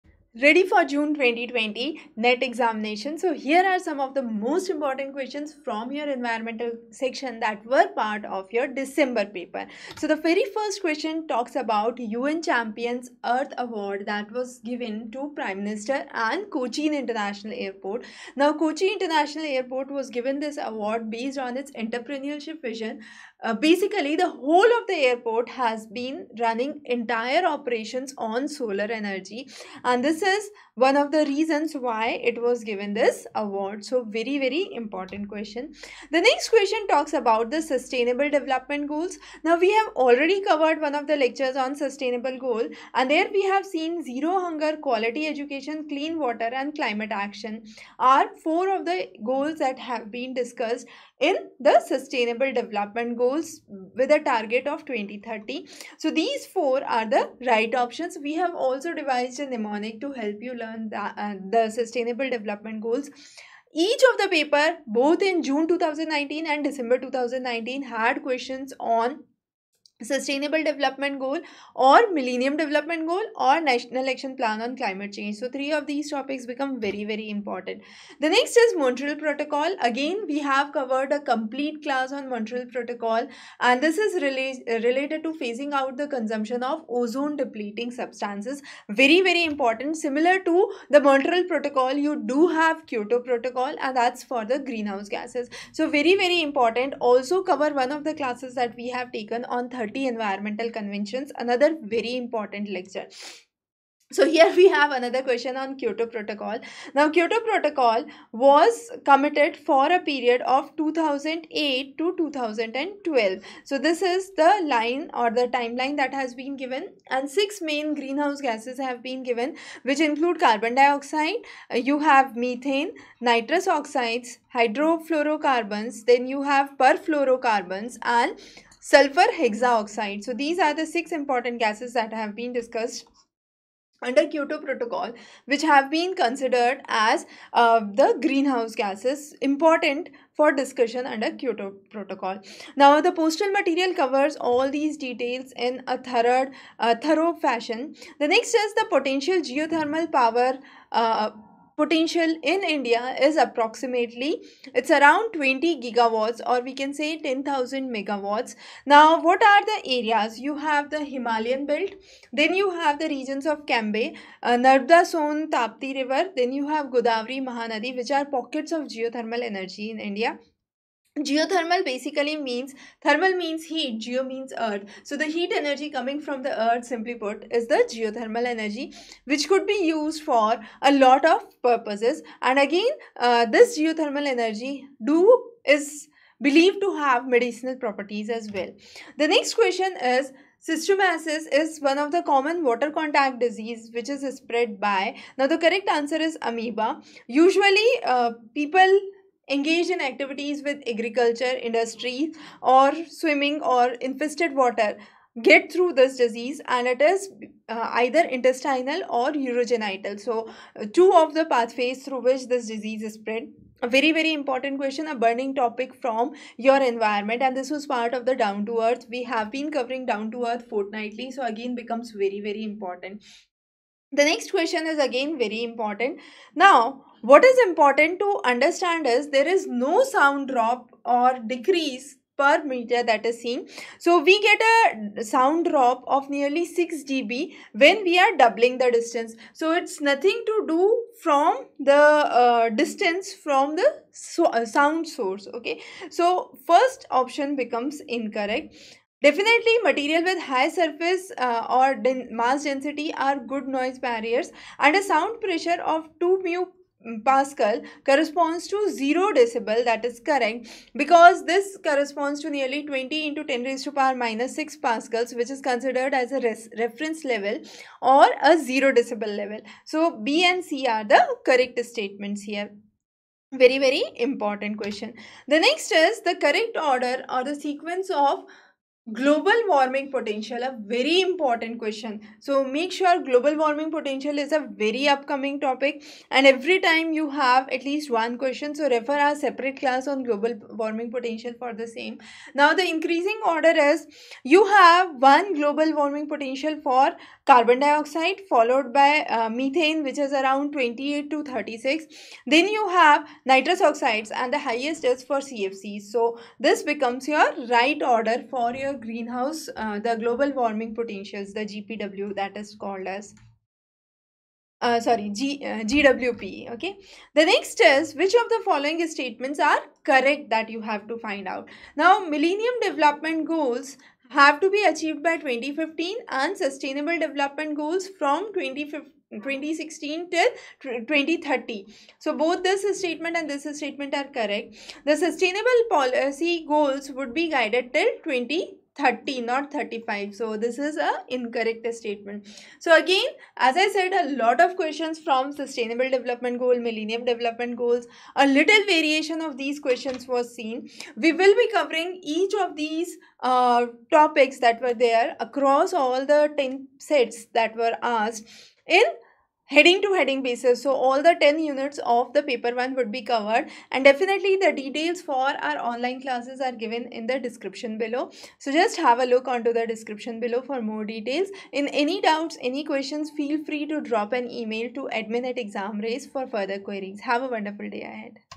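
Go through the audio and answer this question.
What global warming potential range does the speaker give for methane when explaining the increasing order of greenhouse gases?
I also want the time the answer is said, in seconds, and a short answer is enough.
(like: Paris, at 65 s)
28 to 36, at 300 s.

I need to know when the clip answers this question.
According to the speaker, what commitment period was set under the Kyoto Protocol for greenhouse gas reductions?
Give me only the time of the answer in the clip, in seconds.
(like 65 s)
110 s.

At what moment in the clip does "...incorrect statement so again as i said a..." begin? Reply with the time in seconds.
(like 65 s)
341 s.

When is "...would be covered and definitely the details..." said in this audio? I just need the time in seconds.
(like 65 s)
362 s.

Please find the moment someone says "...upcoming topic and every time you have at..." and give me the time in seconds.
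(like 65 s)
285 s.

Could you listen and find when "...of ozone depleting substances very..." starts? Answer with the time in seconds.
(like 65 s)
86 s.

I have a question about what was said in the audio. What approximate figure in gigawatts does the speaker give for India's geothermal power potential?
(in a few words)
20 gigawatts.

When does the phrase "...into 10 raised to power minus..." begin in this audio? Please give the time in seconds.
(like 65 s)
263 s.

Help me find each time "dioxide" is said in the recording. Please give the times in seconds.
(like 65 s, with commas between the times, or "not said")
120 s, 297 s.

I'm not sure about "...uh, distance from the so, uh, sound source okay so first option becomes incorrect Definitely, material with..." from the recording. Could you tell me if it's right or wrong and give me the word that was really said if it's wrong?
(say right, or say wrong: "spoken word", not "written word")
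right.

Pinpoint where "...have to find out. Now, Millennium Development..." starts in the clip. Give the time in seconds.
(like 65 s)
320 s.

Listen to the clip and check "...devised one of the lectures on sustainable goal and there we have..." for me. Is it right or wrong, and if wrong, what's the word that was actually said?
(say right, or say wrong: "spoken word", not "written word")
wrong: "covered", not "devised".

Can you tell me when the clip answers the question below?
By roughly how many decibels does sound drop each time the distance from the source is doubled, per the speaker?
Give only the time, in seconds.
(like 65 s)
236 s.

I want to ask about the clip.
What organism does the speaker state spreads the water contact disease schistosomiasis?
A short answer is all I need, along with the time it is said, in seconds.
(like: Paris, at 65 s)
Amoeba, at 196 s.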